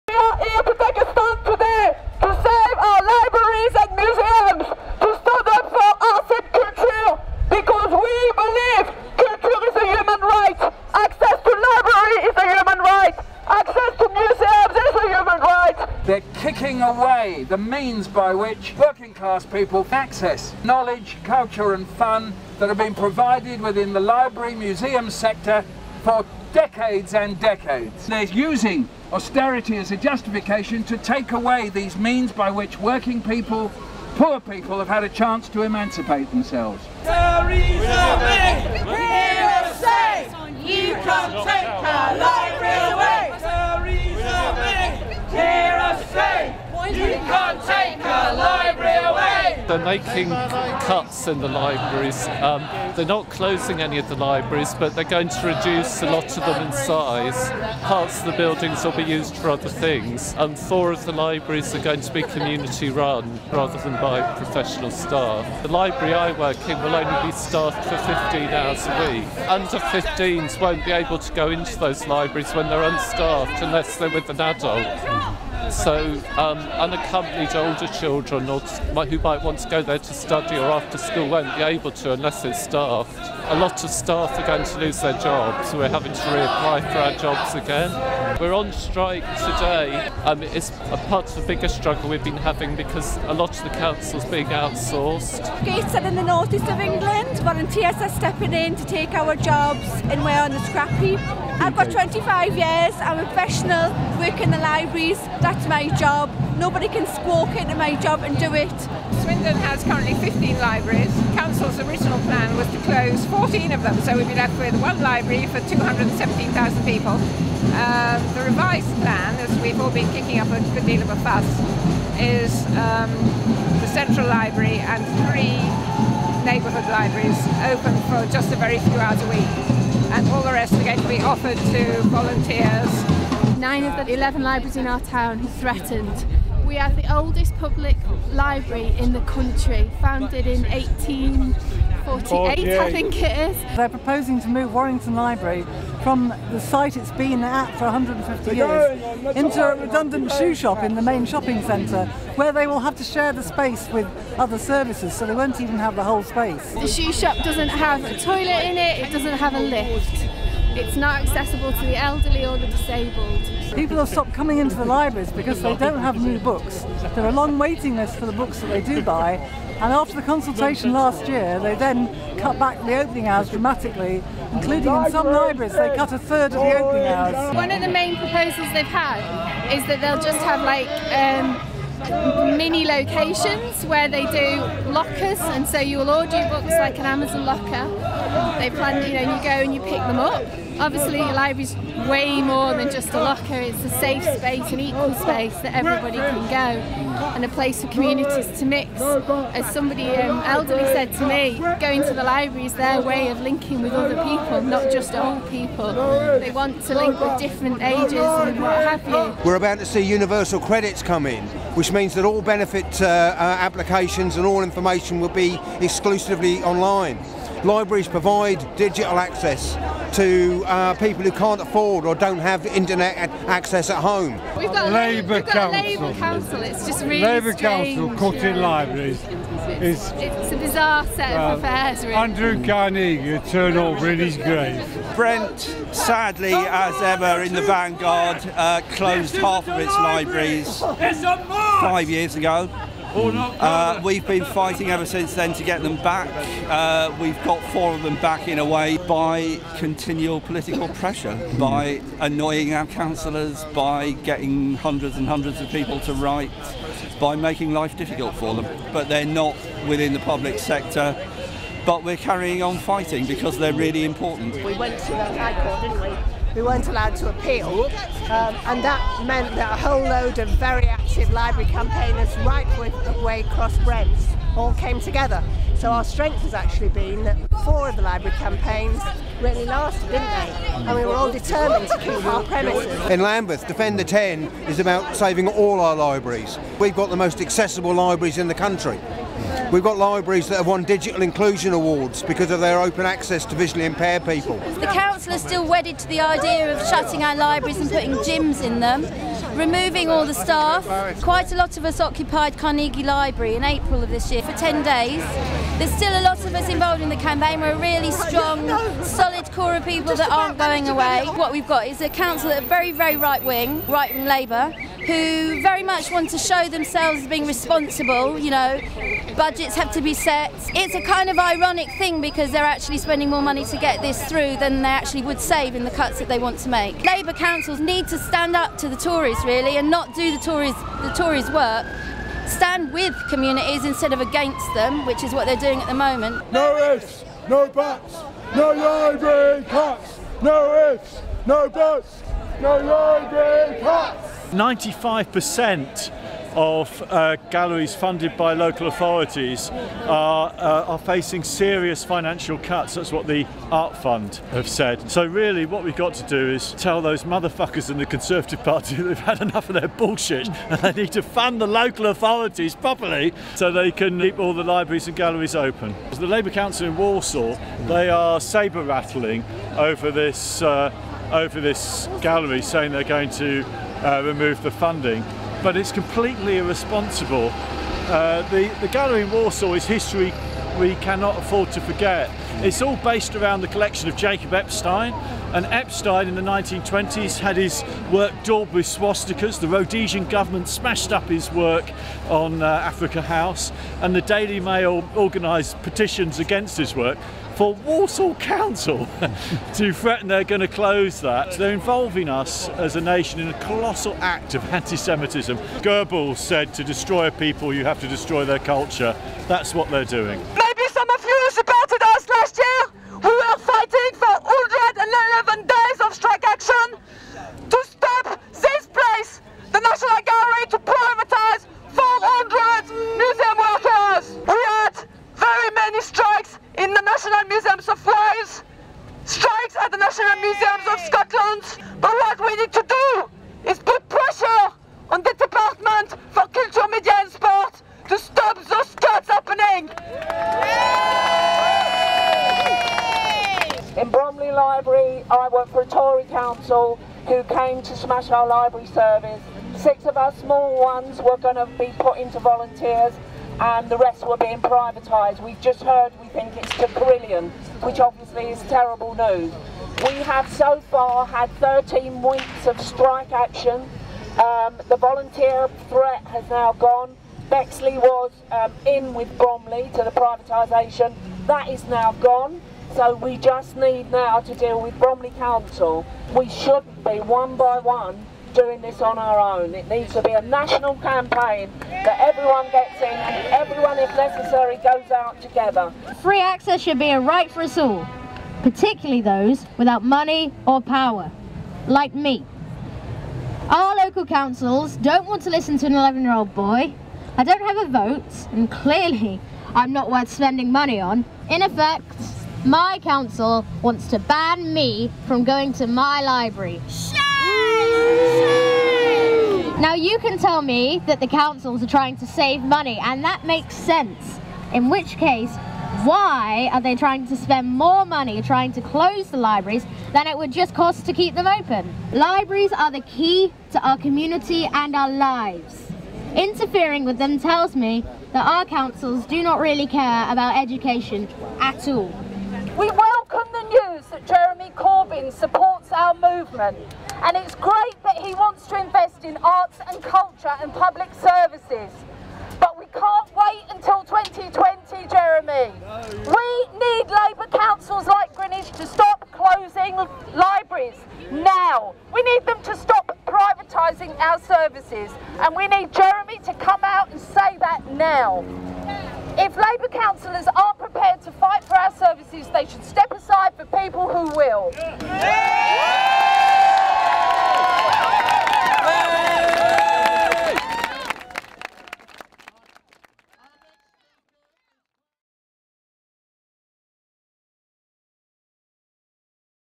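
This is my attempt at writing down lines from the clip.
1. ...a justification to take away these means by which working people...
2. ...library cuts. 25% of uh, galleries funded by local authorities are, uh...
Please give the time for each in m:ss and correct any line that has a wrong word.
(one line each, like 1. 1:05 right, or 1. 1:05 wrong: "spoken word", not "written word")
1. 0:29 right
2. 5:42 wrong: "95", not "25".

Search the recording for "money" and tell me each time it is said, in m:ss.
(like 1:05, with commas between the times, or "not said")
5:23, 8:10, 8:20, 8:32, 8:38.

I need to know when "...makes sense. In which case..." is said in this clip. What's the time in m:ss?
8:33.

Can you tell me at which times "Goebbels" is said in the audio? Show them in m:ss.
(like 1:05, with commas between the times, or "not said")
6:45.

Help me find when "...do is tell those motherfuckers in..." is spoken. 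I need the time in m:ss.
5:56.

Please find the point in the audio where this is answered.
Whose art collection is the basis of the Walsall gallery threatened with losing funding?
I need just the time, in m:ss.
6:24.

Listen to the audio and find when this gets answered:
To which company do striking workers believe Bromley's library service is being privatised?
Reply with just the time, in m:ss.
7:36.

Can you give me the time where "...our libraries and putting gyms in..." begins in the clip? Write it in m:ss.
4:57.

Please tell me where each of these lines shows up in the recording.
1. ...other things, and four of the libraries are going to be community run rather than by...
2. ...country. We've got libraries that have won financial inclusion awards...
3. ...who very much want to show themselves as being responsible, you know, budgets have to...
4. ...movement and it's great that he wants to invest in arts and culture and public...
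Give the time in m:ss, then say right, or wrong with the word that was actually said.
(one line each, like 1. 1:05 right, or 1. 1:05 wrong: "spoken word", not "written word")
1. 0:59 right
2. 4:48 wrong: "digital", not "financial"
3. 5:15 right
4. 8:56 right.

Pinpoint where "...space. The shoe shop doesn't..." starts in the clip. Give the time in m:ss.
2:36.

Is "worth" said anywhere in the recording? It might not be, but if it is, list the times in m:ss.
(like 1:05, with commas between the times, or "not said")
8:20.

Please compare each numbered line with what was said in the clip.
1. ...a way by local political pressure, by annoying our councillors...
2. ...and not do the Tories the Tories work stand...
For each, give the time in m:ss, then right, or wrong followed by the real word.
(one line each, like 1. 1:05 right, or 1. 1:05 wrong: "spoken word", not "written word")
1. 4:08 wrong: "continual", not "local"
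2. 5:29 right.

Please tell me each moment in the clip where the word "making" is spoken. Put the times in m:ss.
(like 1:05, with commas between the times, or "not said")
0:49, 4:17.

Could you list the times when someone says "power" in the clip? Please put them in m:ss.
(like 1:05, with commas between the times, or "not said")
8:10.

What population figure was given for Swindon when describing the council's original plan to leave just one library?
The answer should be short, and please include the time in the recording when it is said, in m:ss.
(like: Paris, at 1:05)
217,000, at 1:55.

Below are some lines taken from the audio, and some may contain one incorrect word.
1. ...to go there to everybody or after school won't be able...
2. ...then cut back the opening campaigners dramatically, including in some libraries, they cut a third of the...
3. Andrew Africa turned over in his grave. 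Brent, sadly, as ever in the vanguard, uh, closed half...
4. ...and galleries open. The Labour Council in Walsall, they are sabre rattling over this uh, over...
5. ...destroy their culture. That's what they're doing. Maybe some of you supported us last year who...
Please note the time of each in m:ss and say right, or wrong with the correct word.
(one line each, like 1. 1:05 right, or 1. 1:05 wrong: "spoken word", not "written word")
1. 1:19 wrong: "study", not "everybody"
2. 2:51 wrong: "hours", not "campaigners"
3. 3:52 wrong: "Carnegie", not "Africa"
4. 6:05 right
5. 6:48 right.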